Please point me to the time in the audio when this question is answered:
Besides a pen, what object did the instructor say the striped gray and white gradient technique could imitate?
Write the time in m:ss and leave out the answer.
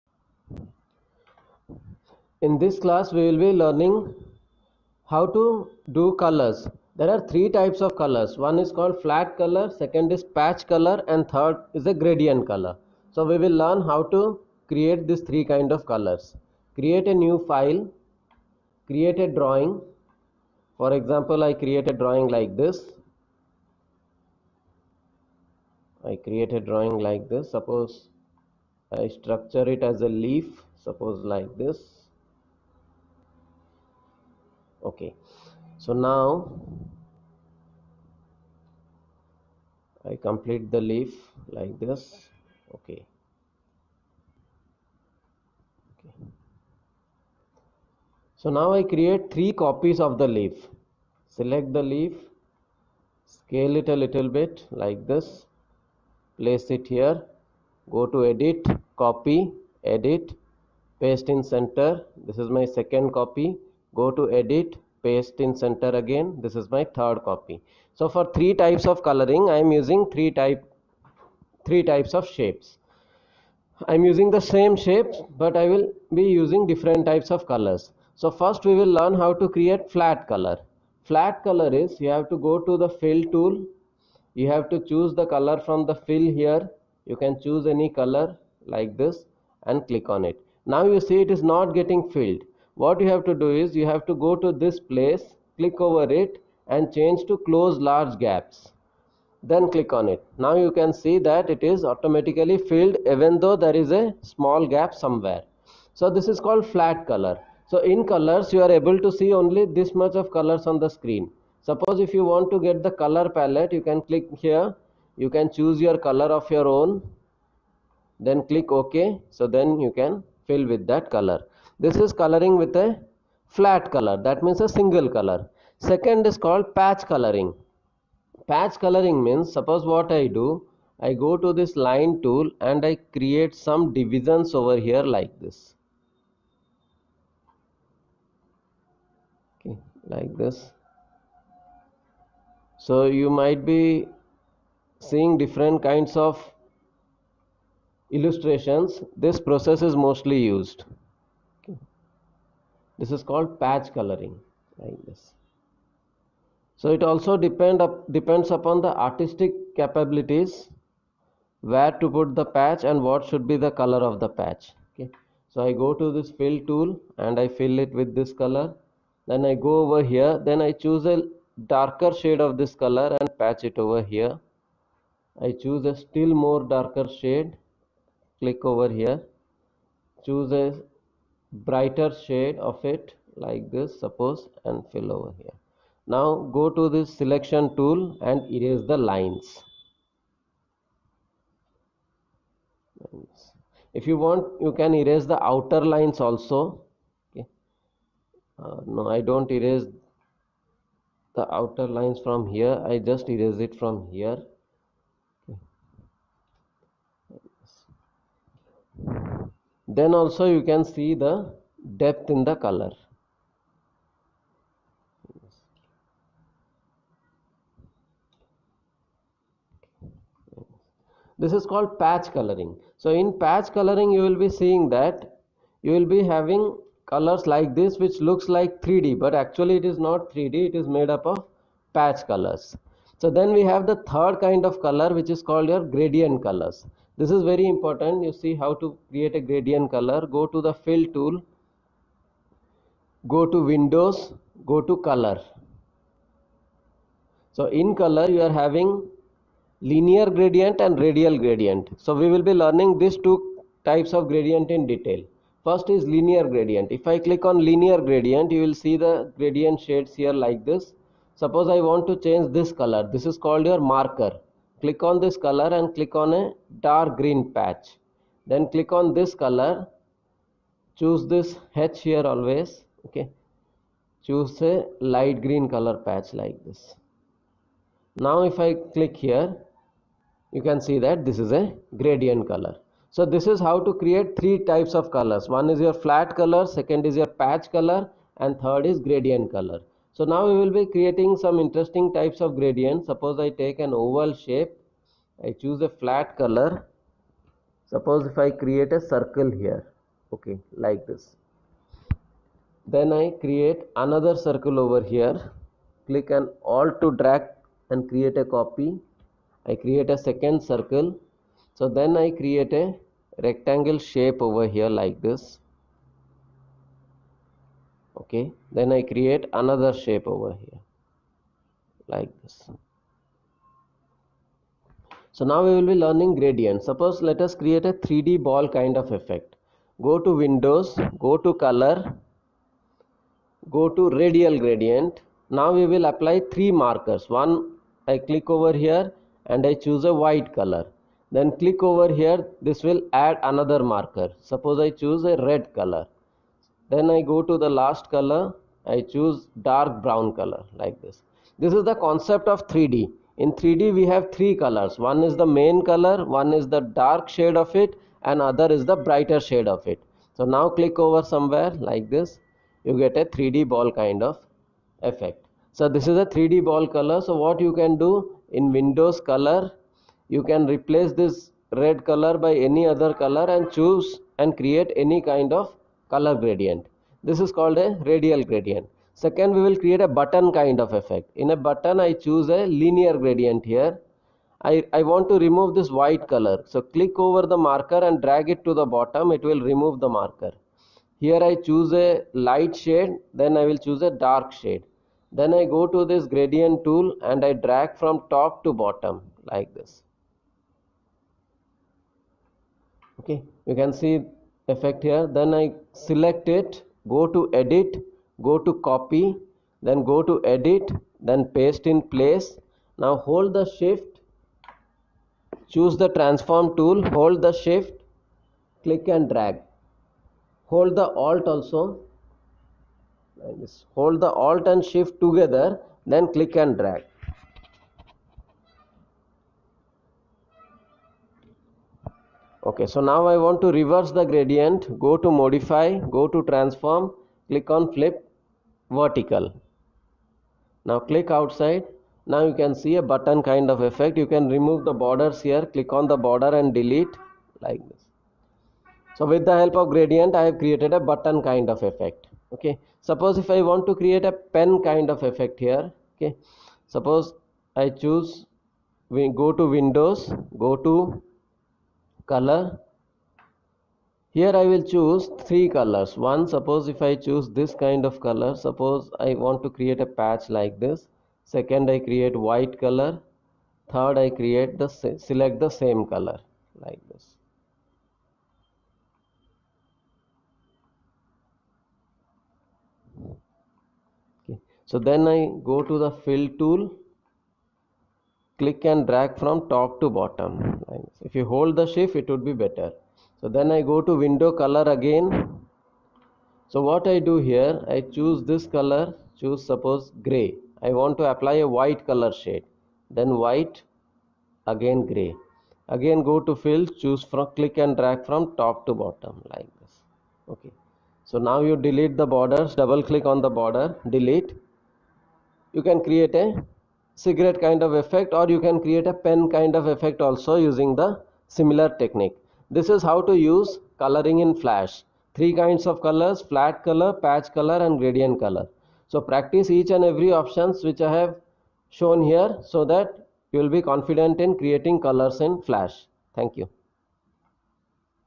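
8:37.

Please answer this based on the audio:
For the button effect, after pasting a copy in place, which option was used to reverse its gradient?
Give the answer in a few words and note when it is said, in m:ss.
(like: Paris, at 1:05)
Flip vertical, at 7:17.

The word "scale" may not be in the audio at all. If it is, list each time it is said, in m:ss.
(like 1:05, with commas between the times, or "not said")
0:53.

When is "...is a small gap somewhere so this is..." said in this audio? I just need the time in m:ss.
1:43.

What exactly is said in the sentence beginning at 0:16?
Create a new file, create a drawing.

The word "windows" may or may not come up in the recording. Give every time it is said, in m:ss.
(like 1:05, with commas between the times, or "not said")
4:03, 5:30, 6:08, 7:39, 8:14.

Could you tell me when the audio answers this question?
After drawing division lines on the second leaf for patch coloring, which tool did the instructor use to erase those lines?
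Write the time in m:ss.
3:07.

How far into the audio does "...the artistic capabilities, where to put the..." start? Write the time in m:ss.
2:38.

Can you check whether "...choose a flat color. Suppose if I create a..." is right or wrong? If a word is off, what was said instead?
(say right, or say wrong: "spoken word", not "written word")
right.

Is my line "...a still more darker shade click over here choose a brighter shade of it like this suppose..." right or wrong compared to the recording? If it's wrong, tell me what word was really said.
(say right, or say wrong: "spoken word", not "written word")
right.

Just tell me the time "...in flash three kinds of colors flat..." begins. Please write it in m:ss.
8:44.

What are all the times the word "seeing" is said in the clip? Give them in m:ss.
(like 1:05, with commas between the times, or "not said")
2:25, 3:44.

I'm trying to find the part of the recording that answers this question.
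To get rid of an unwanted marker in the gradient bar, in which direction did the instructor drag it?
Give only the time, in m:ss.
6:28.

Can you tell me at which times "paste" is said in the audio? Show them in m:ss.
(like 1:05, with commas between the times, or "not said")
1:01, 1:05, 6:51.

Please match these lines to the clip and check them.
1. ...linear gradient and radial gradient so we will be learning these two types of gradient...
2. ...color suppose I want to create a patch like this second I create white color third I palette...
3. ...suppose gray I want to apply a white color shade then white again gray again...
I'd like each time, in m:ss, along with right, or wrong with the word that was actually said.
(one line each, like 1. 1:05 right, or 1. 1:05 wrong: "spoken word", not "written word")
1. 4:09 right
2. 7:48 wrong: "create", not "palette"
3. 8:19 right.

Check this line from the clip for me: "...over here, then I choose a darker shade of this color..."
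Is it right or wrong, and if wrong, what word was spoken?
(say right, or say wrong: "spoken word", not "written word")
right.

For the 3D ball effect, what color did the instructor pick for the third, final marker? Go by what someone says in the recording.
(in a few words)
Dark brown.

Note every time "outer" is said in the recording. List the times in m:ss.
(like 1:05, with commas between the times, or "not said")
3:15, 3:21.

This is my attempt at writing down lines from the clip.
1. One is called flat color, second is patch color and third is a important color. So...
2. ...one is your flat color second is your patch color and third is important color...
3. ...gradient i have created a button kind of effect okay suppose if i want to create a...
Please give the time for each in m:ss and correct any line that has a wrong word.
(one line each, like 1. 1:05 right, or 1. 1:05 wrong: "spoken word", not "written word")
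1. 0:08 wrong: "gradient", not "important"
2. 4:45 wrong: "gradient", not "important"
3. 7:29 right.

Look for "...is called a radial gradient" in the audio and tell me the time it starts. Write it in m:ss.
6:17.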